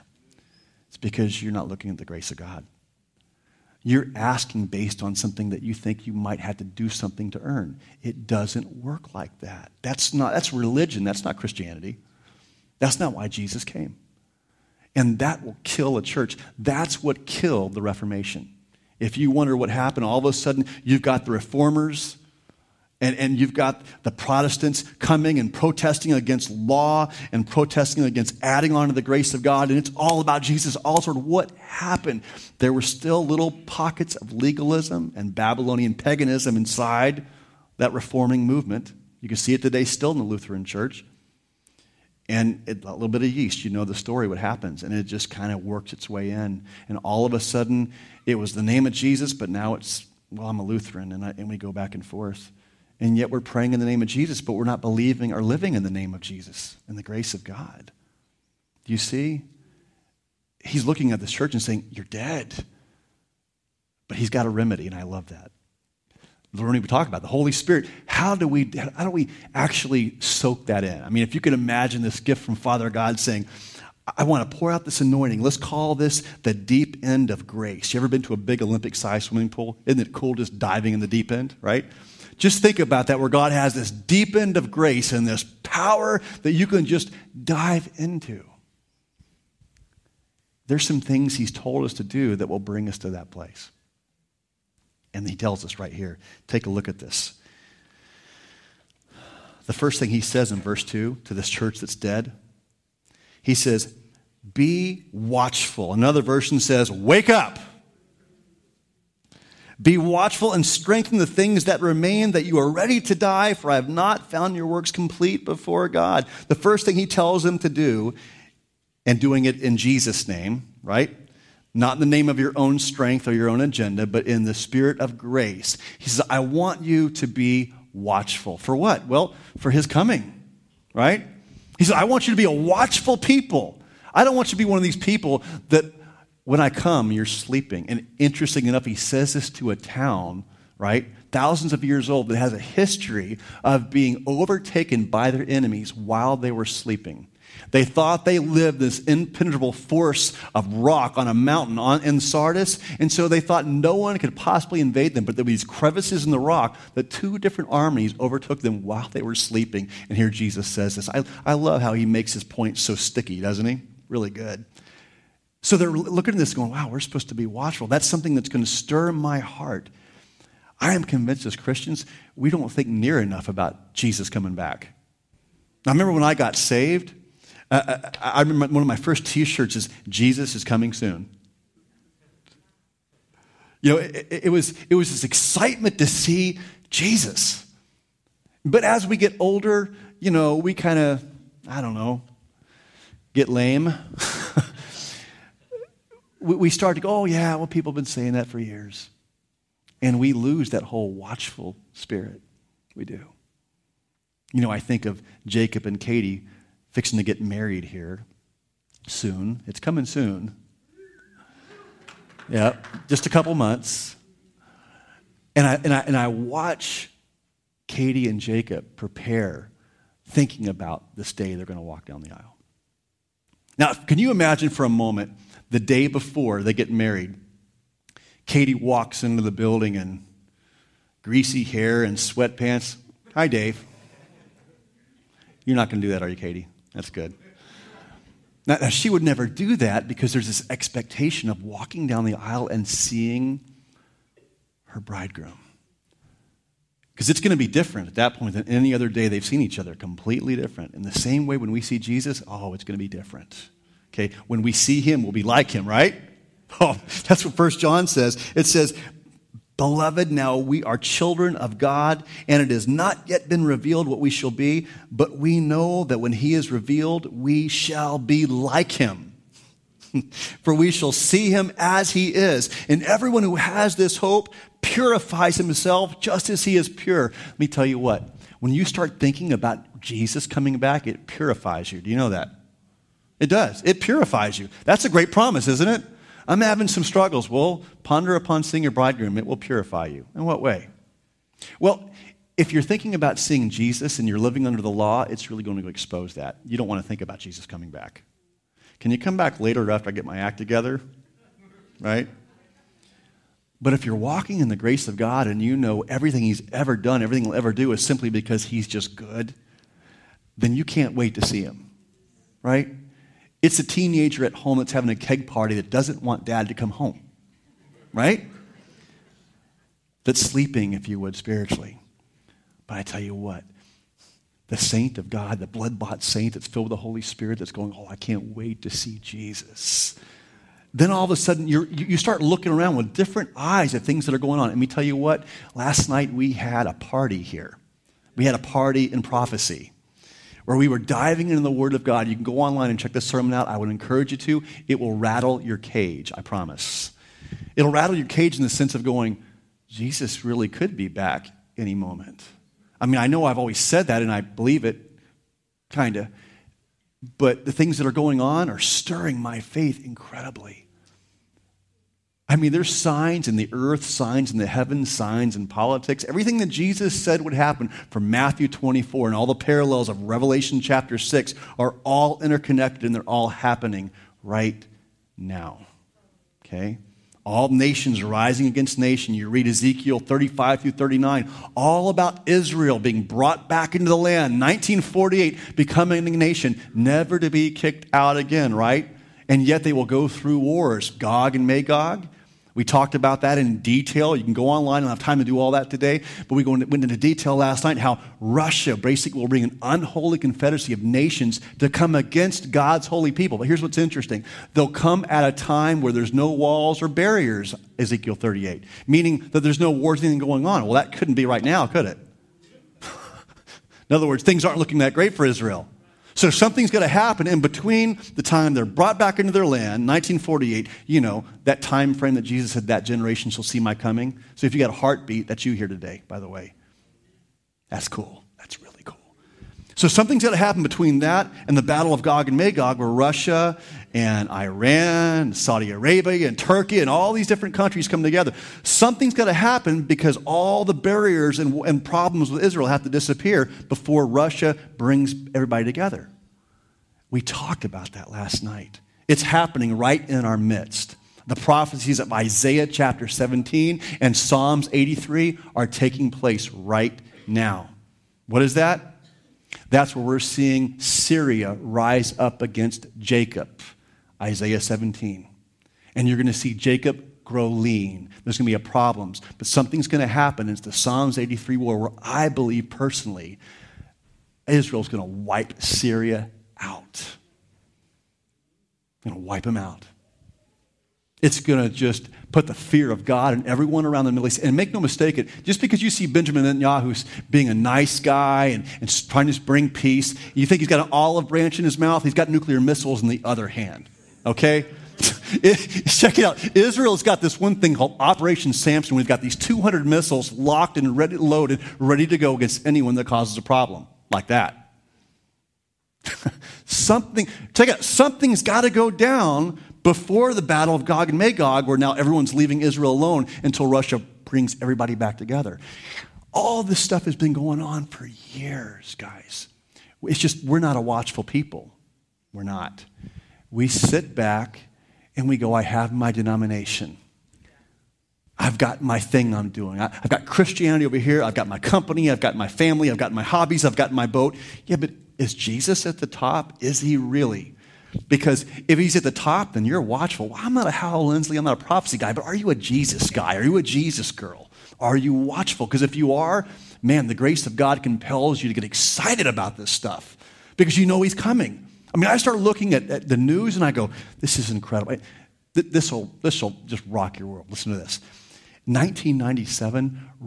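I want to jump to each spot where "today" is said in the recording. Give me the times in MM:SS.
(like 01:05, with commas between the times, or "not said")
00:39, 06:35, 07:05.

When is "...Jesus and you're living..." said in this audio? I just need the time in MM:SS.
04:53.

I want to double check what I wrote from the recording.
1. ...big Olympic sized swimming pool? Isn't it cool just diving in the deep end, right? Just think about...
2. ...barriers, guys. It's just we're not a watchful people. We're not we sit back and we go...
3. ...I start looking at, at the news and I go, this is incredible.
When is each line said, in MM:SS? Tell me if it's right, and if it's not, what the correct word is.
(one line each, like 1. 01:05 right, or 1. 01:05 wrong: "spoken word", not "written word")
1. 01:18 right
2. 08:38 wrong: "years", not "barriers"
3. 09:12 right.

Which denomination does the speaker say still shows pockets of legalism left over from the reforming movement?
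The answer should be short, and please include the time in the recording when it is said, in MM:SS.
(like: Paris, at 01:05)
Lutheran church, at 00:40.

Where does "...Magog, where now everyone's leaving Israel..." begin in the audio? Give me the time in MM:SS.
08:31.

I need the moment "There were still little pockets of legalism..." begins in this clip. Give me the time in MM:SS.
00:32.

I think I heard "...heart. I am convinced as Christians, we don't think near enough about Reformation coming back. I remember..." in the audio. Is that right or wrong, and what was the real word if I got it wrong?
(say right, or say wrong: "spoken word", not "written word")
wrong: "Jesus", not "Reformation".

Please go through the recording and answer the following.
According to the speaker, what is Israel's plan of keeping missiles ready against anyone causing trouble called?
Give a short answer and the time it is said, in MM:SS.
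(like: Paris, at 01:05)
Operation Samson, at 08:18.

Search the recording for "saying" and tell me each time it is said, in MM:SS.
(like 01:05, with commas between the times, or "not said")
01:01, 01:13, 03:18.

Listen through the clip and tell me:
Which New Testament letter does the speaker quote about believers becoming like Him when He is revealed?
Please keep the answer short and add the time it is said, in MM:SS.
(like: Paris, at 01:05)
First John, at 04:17.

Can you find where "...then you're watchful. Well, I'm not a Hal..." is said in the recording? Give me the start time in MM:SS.
08:59.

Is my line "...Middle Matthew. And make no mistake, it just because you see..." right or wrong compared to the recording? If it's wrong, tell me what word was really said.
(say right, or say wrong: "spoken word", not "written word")
wrong: "East", not "Matthew".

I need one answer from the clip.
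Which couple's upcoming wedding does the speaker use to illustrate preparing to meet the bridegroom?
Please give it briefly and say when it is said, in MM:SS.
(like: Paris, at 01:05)
Jacob and Katie, at 03:25.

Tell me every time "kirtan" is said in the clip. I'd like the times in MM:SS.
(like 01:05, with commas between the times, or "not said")
not said.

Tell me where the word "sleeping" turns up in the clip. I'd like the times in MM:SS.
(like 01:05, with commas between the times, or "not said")
02:17, 02:26, 02:39, 05:20.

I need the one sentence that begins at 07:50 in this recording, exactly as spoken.
It's the Psalms 83 war where I believe personally Israel's going to wipe Syria out.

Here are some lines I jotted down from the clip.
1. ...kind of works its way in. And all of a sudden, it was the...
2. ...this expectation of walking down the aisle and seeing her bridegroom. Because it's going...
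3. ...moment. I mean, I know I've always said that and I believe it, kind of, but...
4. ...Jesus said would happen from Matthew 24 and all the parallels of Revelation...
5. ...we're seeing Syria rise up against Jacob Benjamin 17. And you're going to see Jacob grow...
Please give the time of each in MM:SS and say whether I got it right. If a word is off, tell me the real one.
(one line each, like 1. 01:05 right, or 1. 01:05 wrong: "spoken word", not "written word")
1. 00:45 right
2. 04:00 right
3. 05:51 right
4. 06:06 right
5. 07:40 wrong: "Isaiah", not "Benjamin".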